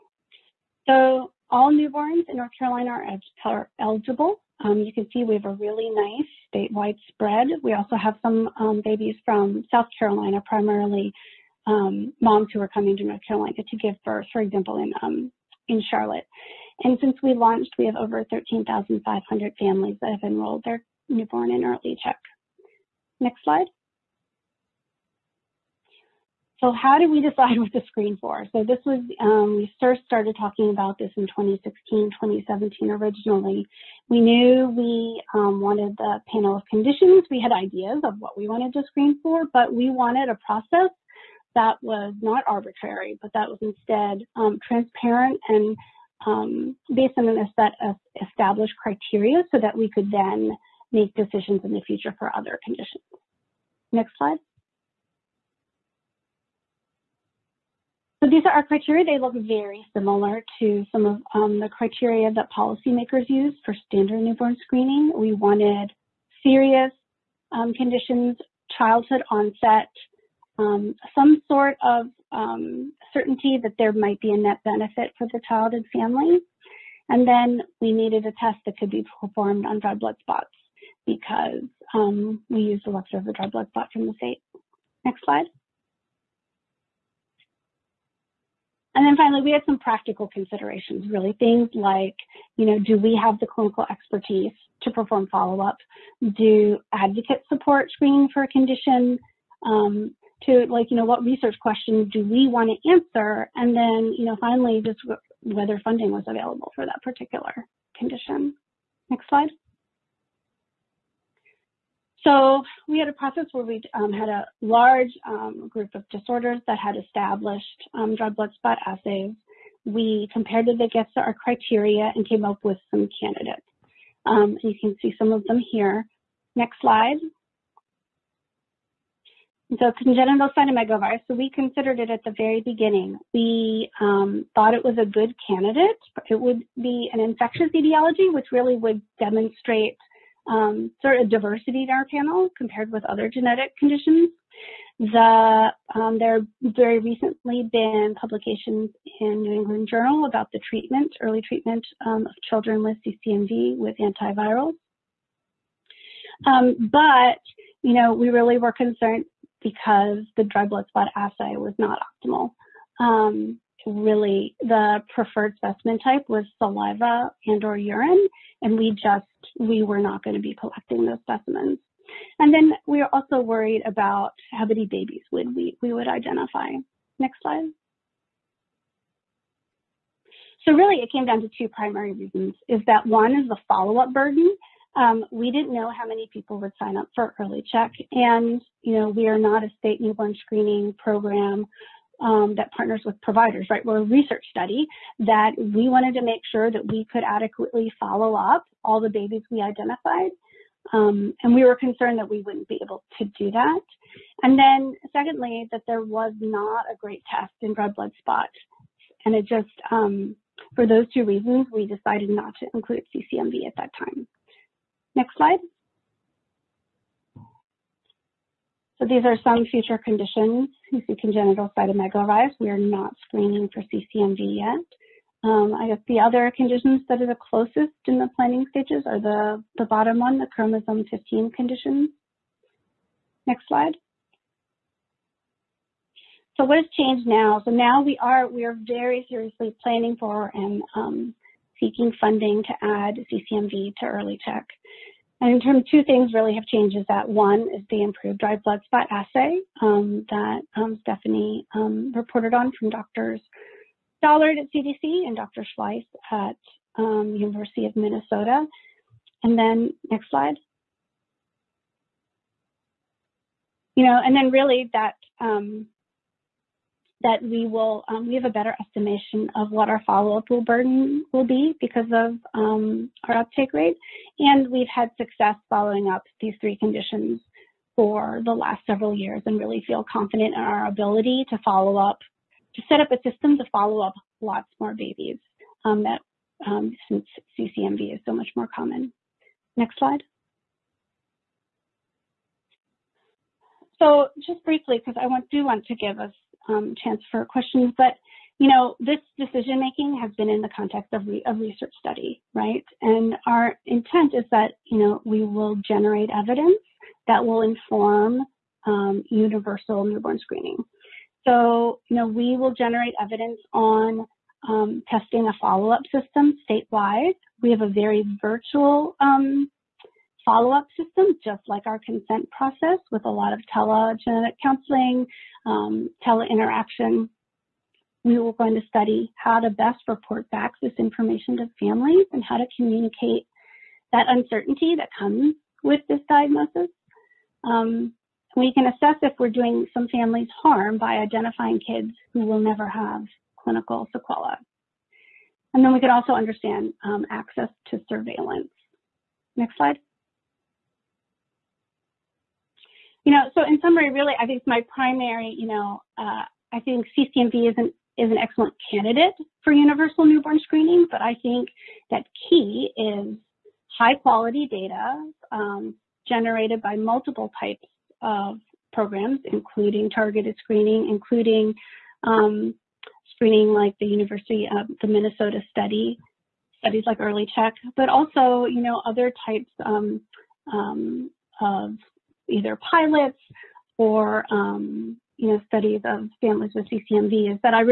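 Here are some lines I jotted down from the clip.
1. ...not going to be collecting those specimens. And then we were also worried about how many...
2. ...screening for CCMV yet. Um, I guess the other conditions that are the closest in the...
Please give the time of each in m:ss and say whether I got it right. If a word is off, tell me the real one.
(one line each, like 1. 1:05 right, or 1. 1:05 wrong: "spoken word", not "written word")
1. 2:49 right
2. 3:43 right.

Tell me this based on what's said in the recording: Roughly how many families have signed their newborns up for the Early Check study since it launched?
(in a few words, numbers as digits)
over 13,500.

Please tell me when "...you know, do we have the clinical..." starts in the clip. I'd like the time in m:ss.
1:32.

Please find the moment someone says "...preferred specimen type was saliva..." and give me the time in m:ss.
2:45.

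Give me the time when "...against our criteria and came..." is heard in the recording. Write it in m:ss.
2:00.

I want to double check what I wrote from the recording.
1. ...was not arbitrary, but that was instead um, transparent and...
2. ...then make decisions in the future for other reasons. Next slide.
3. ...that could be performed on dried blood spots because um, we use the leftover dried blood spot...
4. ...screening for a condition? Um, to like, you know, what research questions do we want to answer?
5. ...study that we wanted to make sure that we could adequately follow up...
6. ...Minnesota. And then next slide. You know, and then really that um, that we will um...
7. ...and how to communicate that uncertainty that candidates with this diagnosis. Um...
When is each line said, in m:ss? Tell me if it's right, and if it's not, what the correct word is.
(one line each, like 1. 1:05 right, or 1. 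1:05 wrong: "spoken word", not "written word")
1. 0:41 right
2. 0:50 wrong: "conditions", not "reasons"
3. 1:18 right
4. 1:37 right
5. 3:14 right
6. 4:17 right
7. 5:32 wrong: "comes", not "candidates".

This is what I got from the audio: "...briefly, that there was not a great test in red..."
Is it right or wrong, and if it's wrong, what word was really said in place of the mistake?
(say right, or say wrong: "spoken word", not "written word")
wrong: "secondly", not "briefly".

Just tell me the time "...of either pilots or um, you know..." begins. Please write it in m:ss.
6:21.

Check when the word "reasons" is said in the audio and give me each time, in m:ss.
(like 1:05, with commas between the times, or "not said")
3:02, 3:31.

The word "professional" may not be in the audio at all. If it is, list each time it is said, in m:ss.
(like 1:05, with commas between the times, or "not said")
not said.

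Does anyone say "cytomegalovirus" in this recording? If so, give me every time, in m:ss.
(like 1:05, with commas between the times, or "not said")
2:10, 3:41.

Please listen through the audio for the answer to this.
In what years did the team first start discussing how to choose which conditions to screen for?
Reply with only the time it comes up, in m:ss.
0:31.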